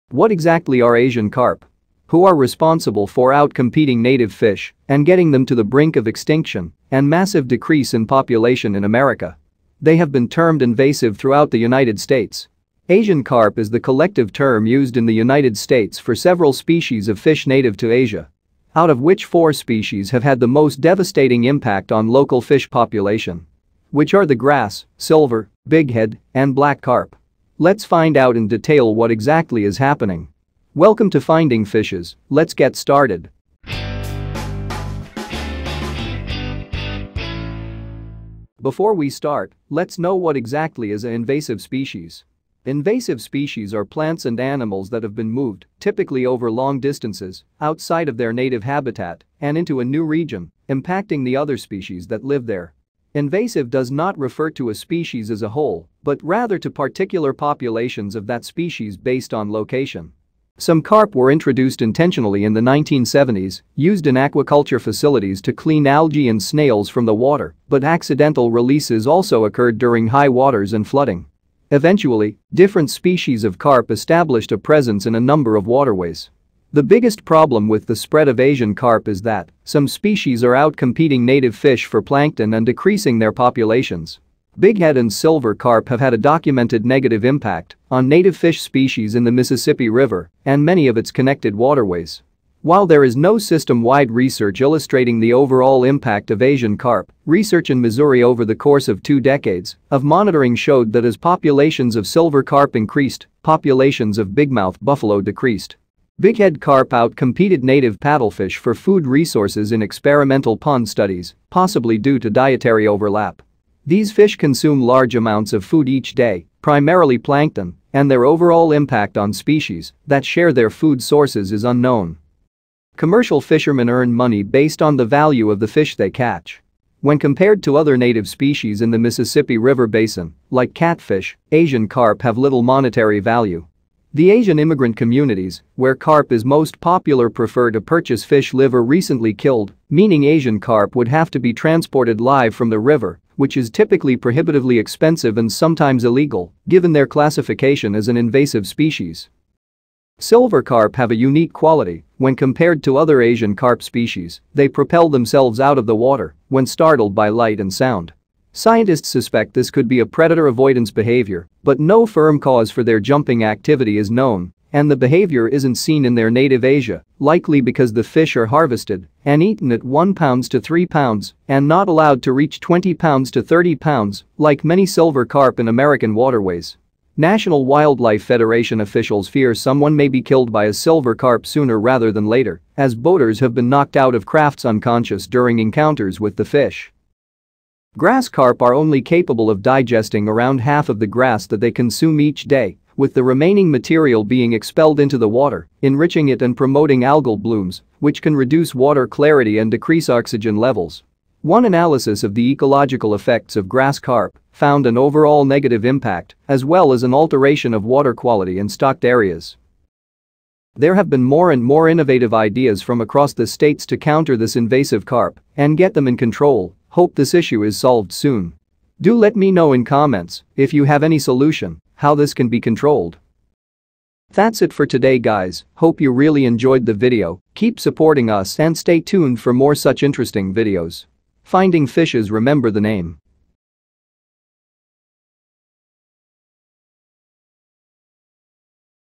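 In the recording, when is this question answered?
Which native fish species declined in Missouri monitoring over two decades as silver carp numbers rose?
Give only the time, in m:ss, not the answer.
1:44.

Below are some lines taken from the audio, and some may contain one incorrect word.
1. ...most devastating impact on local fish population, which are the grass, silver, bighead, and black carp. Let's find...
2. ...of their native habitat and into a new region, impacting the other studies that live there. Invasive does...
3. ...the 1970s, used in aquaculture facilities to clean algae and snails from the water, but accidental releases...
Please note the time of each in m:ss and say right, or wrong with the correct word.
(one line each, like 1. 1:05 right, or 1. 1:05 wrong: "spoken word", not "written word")
1. 0:20 right
2. 0:48 wrong: "species", not "studies"
3. 1:02 right.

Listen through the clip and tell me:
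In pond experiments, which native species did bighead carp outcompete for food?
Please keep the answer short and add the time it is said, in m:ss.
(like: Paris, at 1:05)
paddlefish, at 1:47.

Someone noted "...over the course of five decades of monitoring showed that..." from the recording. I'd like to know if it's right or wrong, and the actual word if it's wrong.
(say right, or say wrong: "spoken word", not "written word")
wrong: "two", not "five".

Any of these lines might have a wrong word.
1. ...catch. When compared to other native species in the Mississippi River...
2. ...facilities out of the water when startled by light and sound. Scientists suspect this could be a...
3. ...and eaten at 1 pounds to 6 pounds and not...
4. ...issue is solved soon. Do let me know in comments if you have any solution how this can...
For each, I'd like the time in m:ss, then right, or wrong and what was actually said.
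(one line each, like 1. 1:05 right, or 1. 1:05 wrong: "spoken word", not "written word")
1. 2:06 right
2. 2:35 wrong: "themselves", not "facilities"
3. 2:49 wrong: "3", not "6"
4. 3:37 right.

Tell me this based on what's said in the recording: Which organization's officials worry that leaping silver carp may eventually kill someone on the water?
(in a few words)
National Wildlife Federation.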